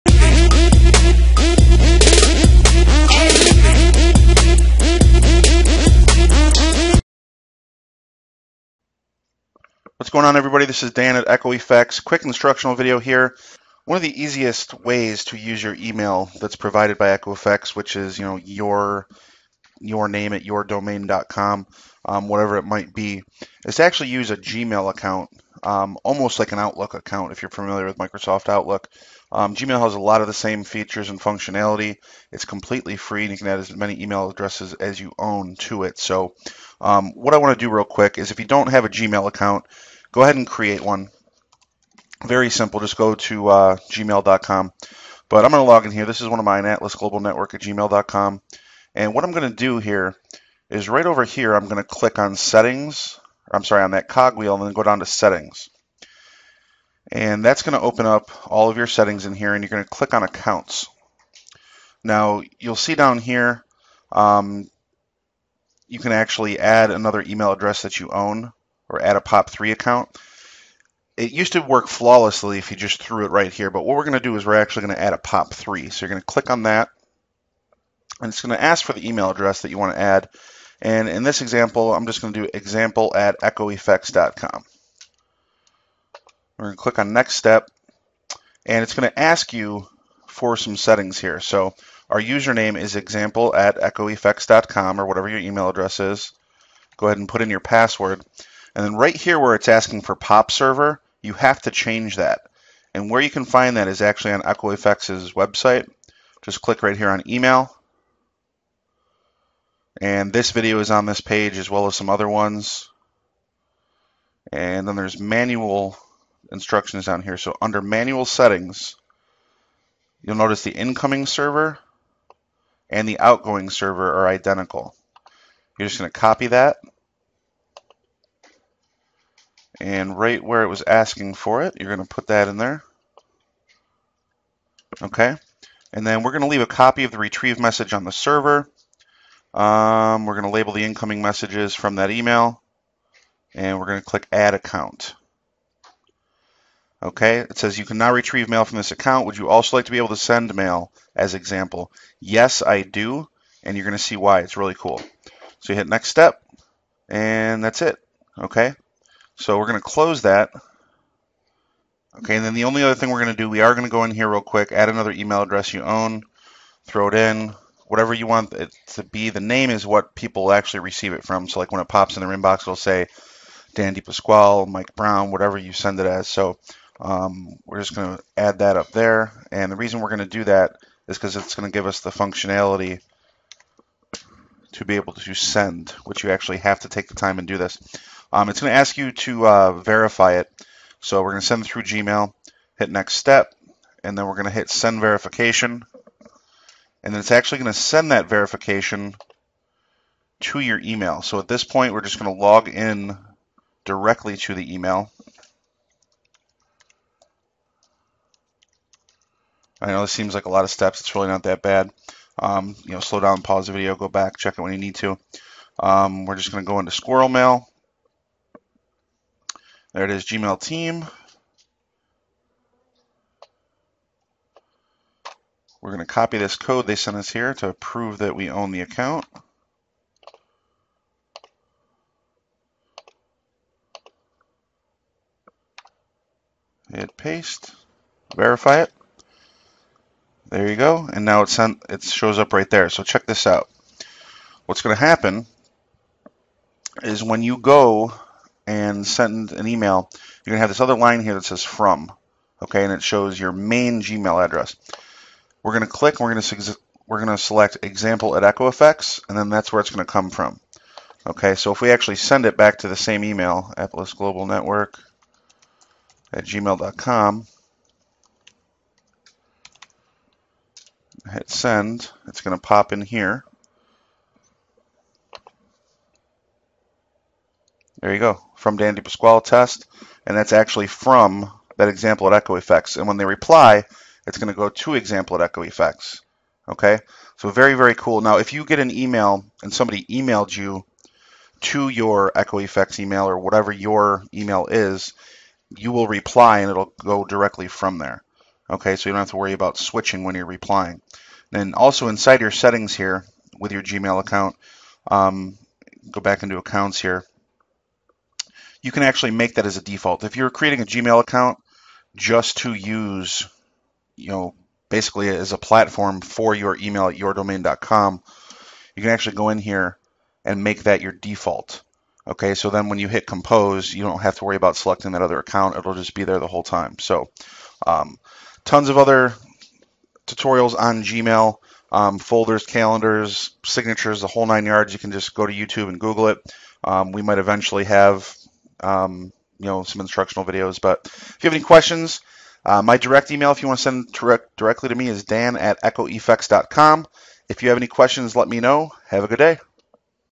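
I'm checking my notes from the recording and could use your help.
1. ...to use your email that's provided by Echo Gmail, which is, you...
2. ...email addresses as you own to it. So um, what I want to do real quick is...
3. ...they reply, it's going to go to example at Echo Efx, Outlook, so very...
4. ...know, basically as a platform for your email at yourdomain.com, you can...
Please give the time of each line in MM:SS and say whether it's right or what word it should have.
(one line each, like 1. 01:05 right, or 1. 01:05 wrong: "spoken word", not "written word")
1. 00:15 wrong: "Efx", not "Gmail"
2. 00:34 right
3. 04:43 wrong: "Okay", not "Outlook"
4. 05:14 right.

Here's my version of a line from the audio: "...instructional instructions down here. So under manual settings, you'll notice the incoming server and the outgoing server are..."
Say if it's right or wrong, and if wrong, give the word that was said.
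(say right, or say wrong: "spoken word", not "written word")
wrong: "manual", not "instructional".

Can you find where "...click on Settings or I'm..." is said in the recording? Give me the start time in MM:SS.
00:51.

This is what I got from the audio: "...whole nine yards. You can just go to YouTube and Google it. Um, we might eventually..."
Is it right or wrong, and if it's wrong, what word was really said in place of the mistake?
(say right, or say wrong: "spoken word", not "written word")
right.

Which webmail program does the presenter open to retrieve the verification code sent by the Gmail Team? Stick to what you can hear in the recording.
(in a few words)
SquirrelMail.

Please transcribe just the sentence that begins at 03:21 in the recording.
So at this point, we're just going to log in directly to the email.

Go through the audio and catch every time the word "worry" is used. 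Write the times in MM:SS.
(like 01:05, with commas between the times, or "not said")
04:59, 05:24.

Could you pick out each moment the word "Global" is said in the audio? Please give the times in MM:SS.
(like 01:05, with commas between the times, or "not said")
00:46, 04:24.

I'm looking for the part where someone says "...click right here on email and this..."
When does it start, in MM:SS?
01:46.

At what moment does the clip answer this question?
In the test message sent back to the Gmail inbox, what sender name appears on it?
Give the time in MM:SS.
04:38.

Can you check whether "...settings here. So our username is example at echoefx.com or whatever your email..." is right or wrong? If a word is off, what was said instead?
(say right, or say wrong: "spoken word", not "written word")
right.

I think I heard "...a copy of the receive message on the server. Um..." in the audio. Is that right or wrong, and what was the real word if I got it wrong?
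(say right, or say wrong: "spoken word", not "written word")
wrong: "retrieve", not "receive".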